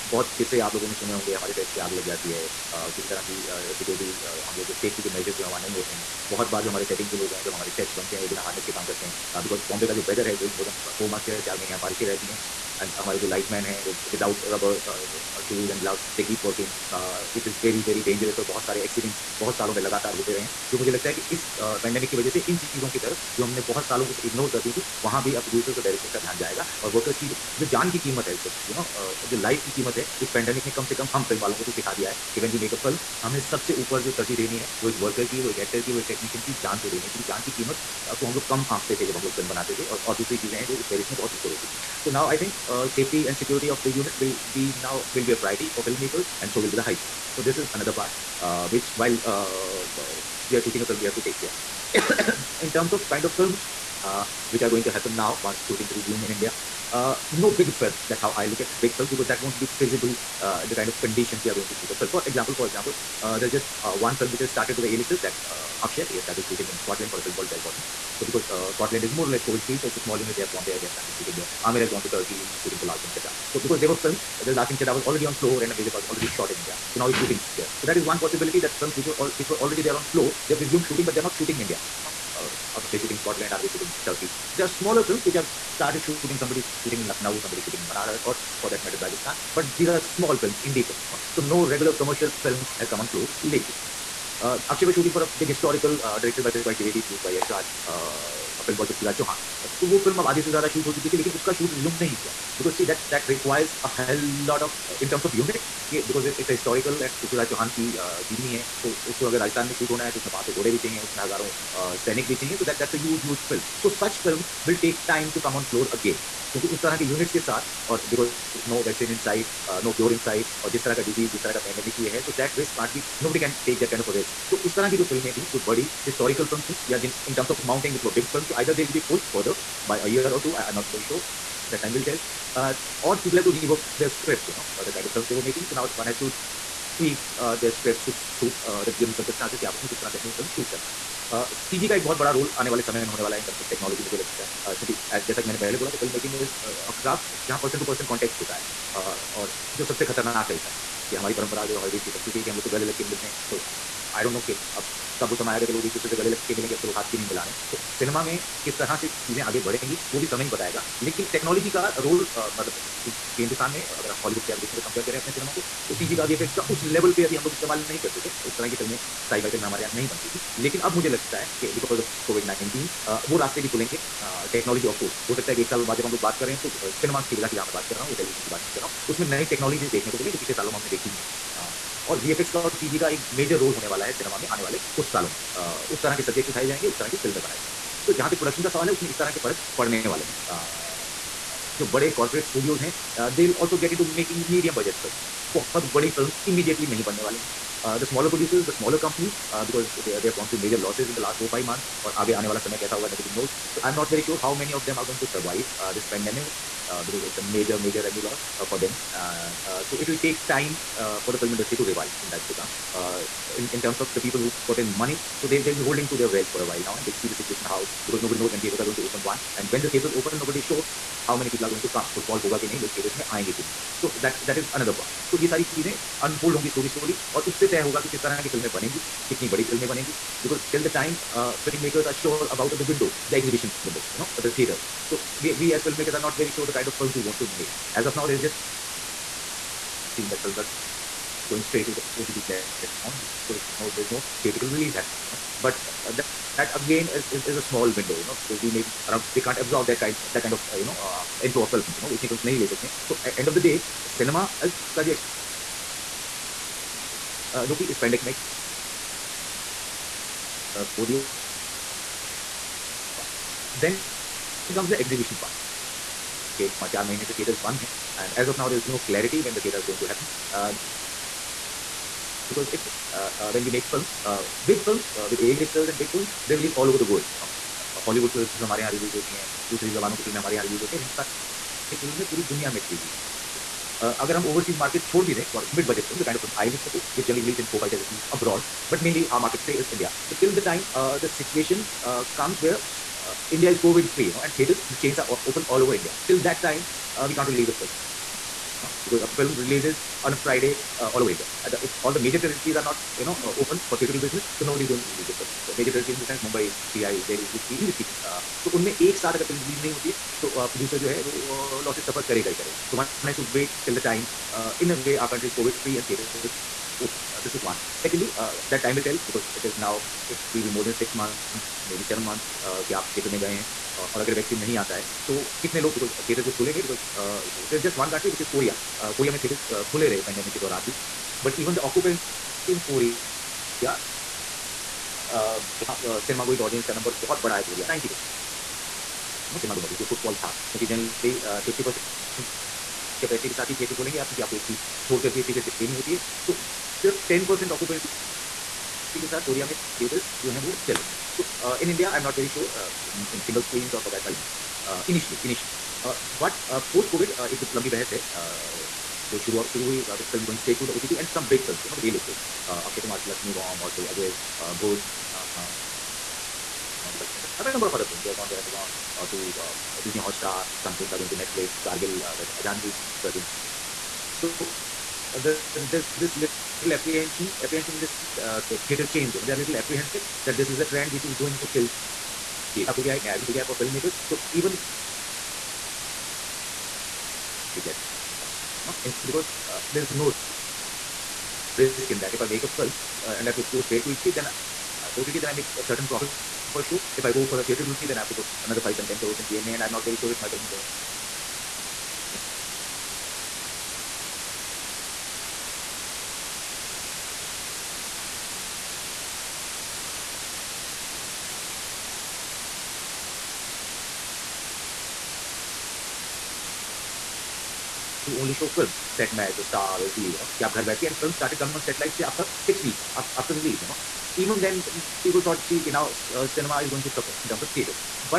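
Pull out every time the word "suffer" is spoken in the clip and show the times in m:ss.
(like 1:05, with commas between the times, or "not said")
5:12, 7:07.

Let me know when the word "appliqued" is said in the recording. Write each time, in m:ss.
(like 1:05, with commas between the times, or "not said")
not said.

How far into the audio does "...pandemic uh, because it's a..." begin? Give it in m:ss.
3:26.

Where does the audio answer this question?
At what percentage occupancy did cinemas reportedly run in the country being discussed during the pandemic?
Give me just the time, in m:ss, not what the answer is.
5:47.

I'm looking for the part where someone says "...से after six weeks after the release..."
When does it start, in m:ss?
7:02.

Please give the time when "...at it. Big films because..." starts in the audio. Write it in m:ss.
0:58.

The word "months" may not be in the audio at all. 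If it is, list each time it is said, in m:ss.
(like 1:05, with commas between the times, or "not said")
3:21, 5:21.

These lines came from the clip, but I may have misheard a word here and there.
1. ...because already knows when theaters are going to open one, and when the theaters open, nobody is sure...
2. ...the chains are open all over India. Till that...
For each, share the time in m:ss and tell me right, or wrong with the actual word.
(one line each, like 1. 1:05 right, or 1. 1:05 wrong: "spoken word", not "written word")
1. 3:38 wrong: "nobody", not "already"
2. 4:54 right.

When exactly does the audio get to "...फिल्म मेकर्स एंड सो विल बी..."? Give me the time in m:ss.
0:45.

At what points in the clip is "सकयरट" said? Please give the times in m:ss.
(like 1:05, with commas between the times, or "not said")
0:03, 0:43.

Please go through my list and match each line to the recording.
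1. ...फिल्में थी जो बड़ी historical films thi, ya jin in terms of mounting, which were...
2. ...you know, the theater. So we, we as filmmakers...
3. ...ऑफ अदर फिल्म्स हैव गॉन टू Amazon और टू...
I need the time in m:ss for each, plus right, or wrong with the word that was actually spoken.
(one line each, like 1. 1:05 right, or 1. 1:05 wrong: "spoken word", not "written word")
1. 2:05 right
2. 3:54 right
3. 6:07 right.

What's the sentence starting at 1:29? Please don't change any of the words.
But these are small films, indie films.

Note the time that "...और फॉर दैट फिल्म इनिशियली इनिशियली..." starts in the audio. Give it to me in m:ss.
5:53.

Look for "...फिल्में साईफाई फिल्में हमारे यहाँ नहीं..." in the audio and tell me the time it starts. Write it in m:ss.
2:48.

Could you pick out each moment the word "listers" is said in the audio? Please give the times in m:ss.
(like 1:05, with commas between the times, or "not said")
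1:04, 4:35.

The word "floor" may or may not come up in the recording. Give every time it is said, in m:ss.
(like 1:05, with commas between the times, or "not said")
1:15, 1:20, 1:33.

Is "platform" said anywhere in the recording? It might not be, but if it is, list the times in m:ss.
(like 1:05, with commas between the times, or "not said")
4:02, 6:27.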